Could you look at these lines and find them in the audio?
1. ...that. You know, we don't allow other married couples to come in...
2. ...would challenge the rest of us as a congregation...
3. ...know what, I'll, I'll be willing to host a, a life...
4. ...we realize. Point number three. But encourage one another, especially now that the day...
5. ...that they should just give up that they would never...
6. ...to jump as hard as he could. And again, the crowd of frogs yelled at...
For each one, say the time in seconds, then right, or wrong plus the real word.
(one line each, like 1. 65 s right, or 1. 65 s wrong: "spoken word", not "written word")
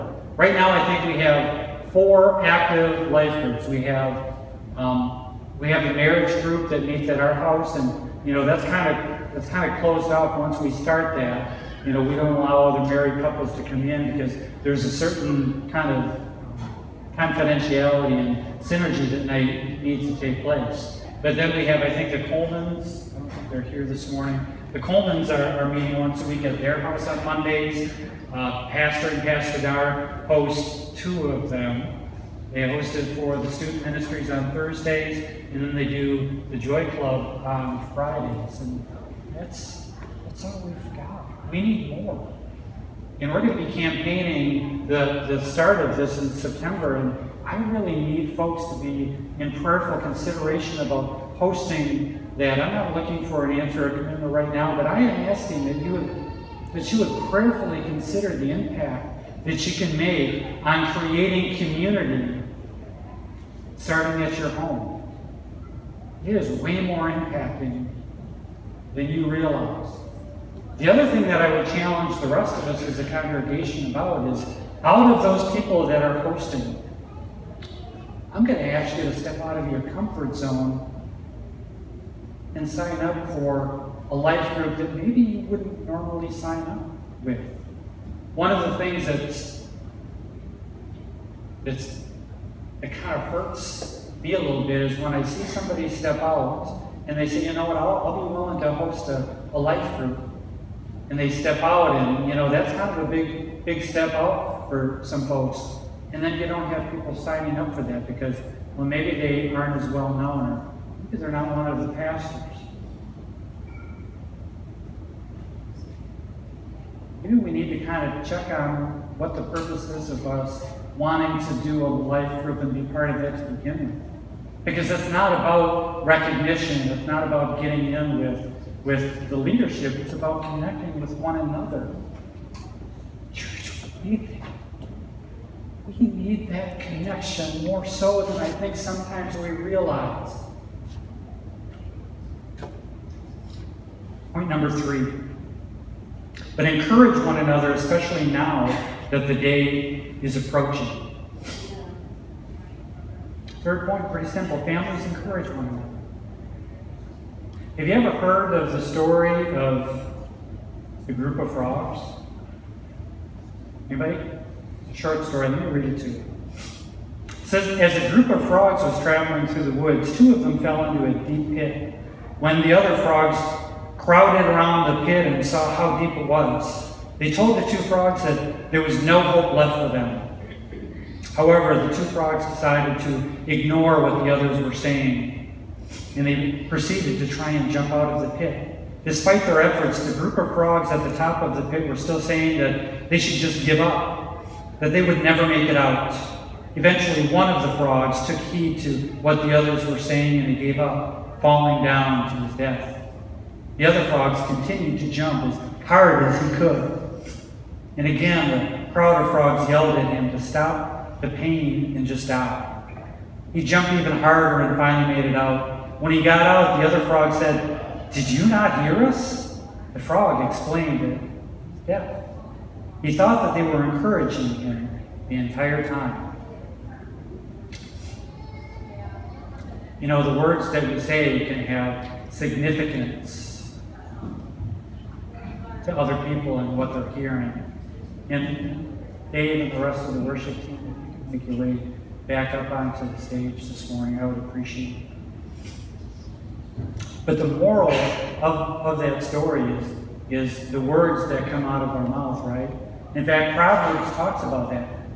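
1. 11 s right
2. 71 s right
3. 97 s right
4. 139 s right
5. 192 s right
6. 205 s right.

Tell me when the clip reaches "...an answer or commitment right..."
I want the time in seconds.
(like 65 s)
53 s.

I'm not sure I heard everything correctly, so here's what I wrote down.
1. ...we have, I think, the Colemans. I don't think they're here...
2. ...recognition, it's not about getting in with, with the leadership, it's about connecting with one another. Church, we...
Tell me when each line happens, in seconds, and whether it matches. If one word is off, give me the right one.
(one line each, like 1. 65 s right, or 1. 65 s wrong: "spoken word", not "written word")
1. 21 s right
2. 126 s right.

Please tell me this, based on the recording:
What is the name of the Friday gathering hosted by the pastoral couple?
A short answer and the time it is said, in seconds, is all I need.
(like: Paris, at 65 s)
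Joy Club, at 36 s.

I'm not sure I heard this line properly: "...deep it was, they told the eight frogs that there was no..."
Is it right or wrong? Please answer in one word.
wrong.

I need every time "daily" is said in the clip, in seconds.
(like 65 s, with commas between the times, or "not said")
not said.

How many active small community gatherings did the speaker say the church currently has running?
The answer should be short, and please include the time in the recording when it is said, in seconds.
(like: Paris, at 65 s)
4, at 1 s.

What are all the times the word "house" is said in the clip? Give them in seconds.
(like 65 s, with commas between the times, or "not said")
7 s, 26 s.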